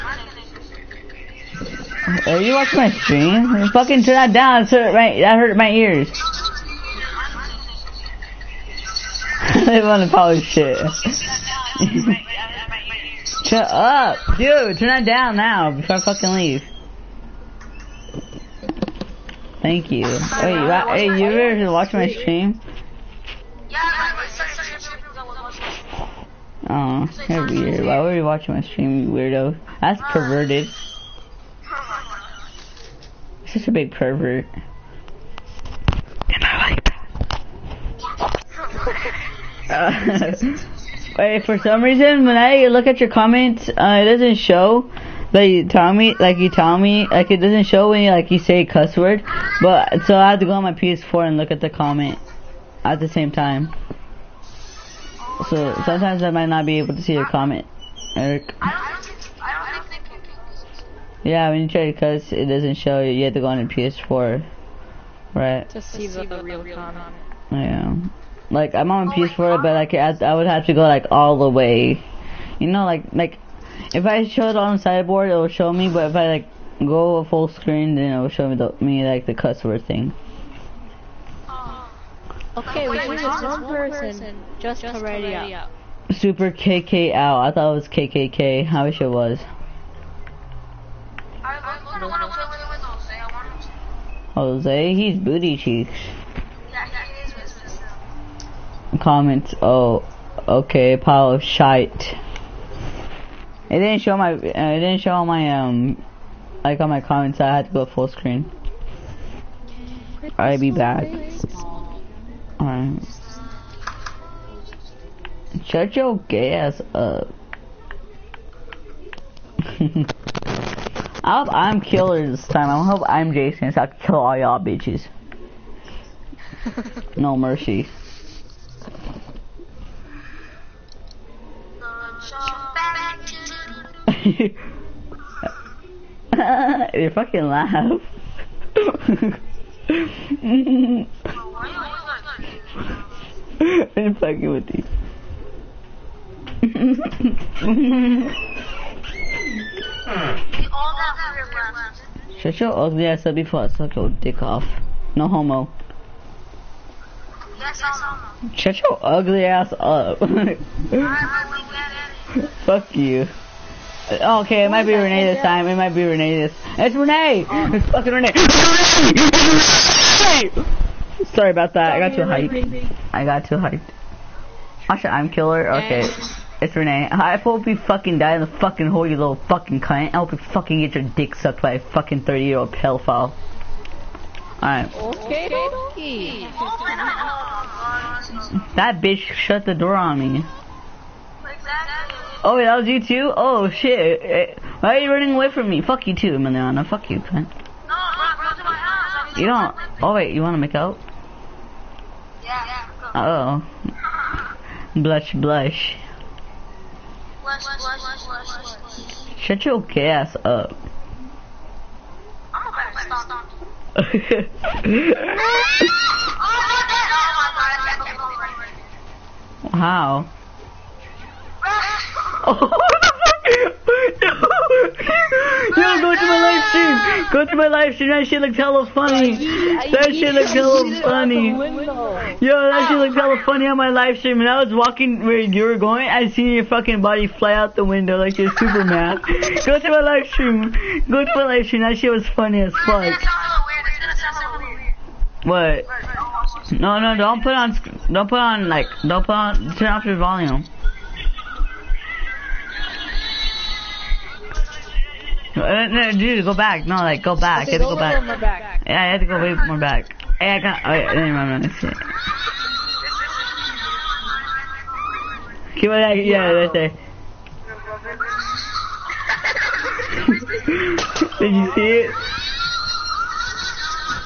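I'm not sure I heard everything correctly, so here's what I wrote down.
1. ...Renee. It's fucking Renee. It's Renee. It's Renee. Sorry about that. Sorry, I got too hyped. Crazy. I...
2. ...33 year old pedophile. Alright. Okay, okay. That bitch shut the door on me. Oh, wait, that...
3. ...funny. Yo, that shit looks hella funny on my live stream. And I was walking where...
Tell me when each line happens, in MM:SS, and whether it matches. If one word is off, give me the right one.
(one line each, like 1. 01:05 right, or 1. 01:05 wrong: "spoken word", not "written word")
1. 02:46 right
2. 03:02 wrong: "30", not "33"
3. 03:51 right.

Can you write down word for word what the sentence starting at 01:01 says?
Yeah, when you try to cuss, it doesn't show you.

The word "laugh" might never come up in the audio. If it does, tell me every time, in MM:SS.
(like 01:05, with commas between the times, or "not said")
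02:17.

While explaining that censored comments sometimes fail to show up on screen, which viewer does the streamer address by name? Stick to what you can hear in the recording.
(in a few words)
Eric.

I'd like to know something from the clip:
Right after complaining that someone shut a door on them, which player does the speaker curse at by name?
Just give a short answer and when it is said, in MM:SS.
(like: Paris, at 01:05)
Emiliana, at 03:16.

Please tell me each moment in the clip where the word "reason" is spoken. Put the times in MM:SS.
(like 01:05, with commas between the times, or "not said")
00:41.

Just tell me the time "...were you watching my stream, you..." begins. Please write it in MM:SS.
00:28.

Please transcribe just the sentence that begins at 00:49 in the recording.
But so I have to go on my PS4 and look at the comment at the same time.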